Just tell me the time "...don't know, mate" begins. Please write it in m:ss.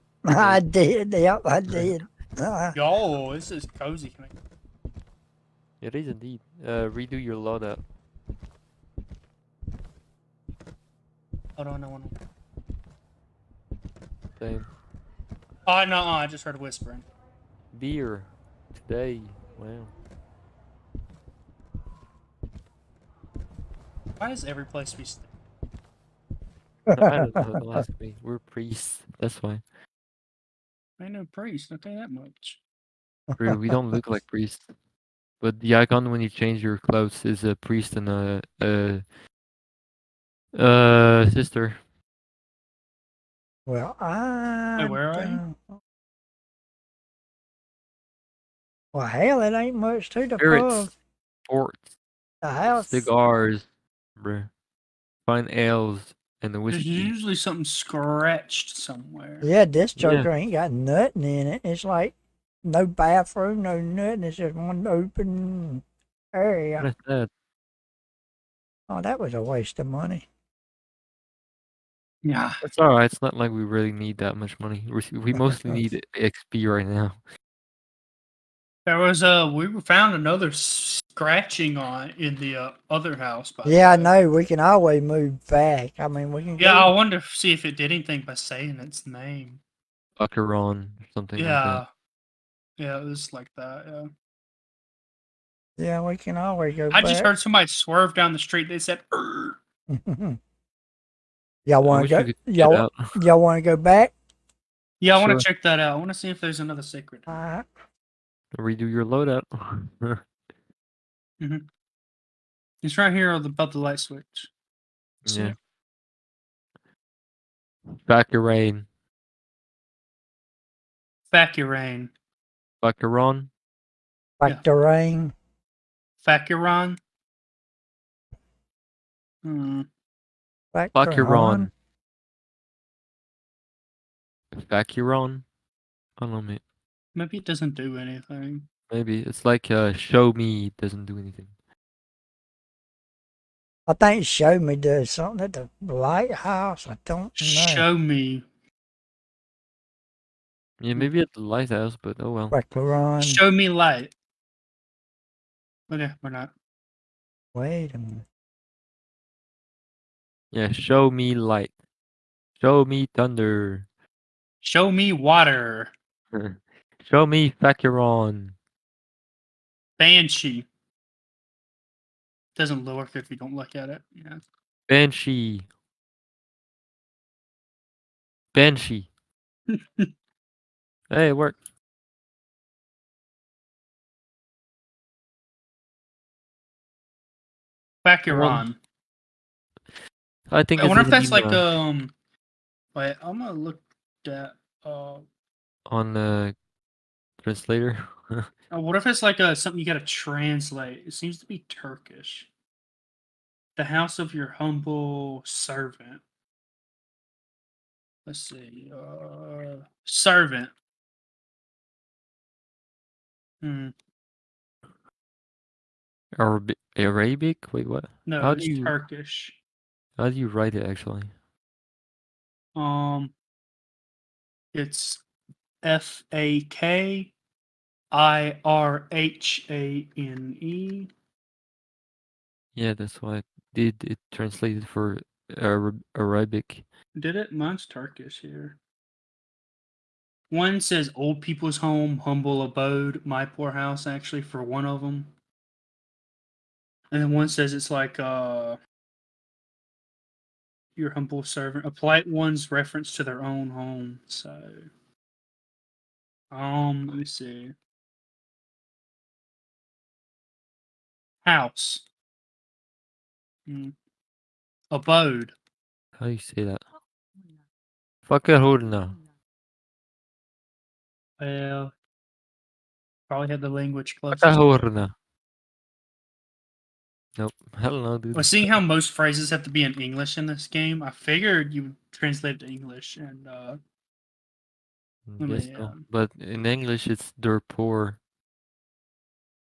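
2:16.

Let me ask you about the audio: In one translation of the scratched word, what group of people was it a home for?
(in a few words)
Old people.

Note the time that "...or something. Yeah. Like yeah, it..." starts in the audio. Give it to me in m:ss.
1:31.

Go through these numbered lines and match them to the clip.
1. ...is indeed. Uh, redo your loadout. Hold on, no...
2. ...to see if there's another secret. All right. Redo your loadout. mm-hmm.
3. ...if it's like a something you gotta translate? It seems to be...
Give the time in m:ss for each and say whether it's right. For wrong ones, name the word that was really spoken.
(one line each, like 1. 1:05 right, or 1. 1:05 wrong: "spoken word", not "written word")
1. 0:05 right
2. 1:46 right
3. 3:18 right.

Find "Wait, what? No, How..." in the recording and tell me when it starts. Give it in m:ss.
3:37.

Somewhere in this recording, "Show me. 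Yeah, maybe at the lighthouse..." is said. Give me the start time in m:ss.
2:27.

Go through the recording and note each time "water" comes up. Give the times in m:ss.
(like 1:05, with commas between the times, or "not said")
2:45.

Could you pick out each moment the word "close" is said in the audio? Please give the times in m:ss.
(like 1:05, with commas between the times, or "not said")
4:34.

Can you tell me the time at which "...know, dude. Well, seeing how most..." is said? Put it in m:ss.
4:38.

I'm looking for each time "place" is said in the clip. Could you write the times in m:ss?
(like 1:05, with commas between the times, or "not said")
0:24.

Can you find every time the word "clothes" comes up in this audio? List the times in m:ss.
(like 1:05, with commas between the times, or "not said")
0:36.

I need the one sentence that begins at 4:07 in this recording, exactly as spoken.
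And then one says it's like, uh, your humble servant, a polite one's reference to their own home.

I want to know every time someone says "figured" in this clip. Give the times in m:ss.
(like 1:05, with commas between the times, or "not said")
4:41.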